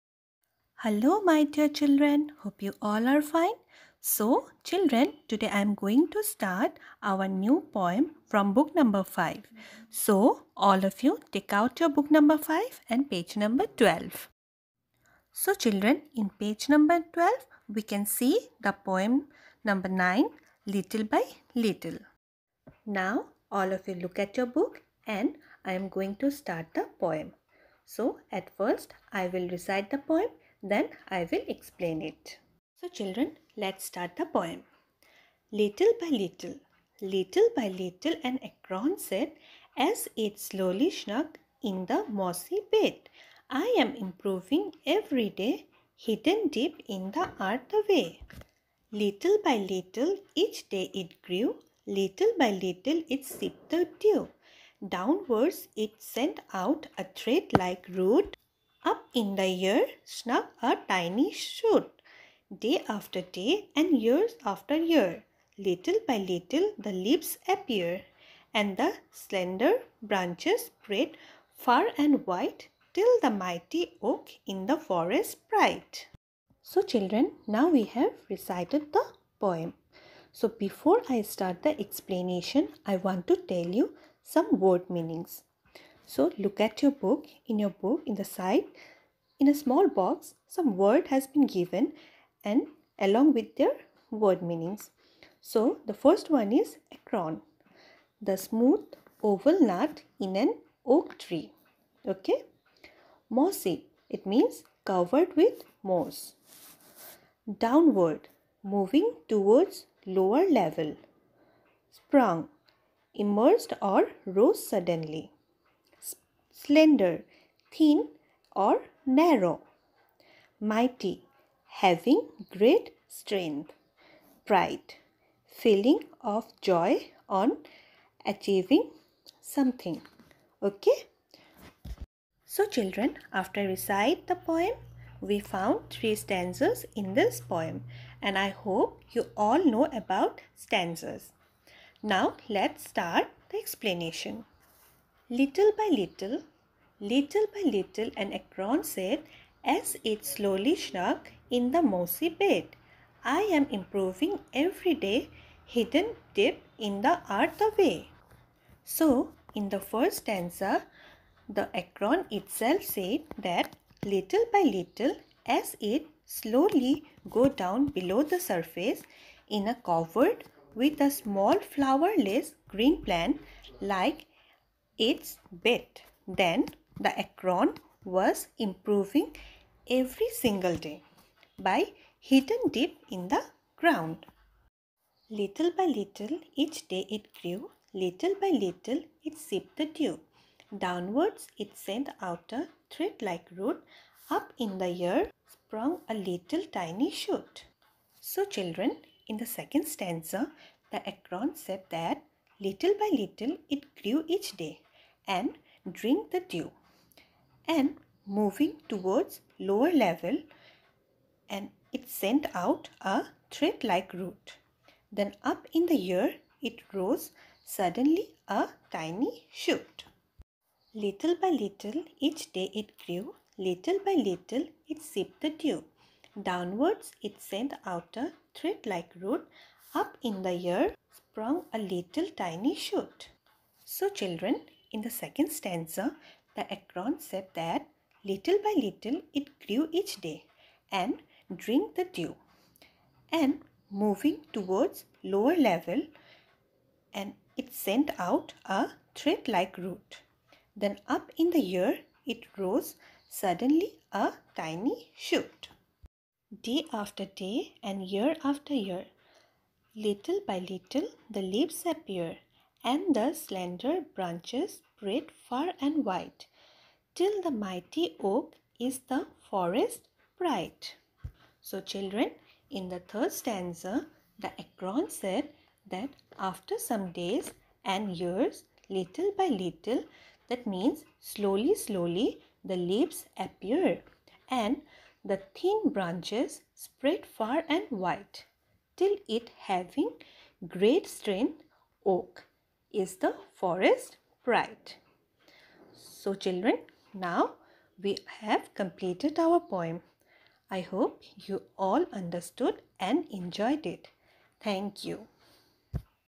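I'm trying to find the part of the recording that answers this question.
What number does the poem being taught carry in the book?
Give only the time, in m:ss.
0:18.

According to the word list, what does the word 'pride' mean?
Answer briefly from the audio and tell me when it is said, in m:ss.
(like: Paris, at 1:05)
feeling of joy on achieving something, at 2:05.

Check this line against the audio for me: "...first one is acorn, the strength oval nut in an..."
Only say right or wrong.
wrong.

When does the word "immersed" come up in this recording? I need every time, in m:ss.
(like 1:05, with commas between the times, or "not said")
1:53.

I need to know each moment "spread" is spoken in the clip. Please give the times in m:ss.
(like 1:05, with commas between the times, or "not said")
1:10, 4:24, 4:46.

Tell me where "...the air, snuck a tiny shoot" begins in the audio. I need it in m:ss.
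0:59.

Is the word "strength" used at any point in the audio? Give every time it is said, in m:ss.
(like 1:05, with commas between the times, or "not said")
2:03, 4:51.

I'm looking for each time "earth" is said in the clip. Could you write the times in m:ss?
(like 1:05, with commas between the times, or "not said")
0:47, 2:37.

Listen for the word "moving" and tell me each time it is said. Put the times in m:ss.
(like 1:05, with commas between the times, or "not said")
1:48, 3:28, 4:03.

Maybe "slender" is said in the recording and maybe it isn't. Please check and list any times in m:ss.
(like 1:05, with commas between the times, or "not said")
1:09, 1:56, 4:23.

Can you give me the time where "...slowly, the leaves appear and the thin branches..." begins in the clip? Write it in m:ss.
4:41.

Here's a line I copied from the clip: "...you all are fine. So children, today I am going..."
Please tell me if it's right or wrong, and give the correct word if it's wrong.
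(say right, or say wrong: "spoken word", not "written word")
right.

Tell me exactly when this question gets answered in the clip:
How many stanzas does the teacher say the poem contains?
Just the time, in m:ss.
2:15.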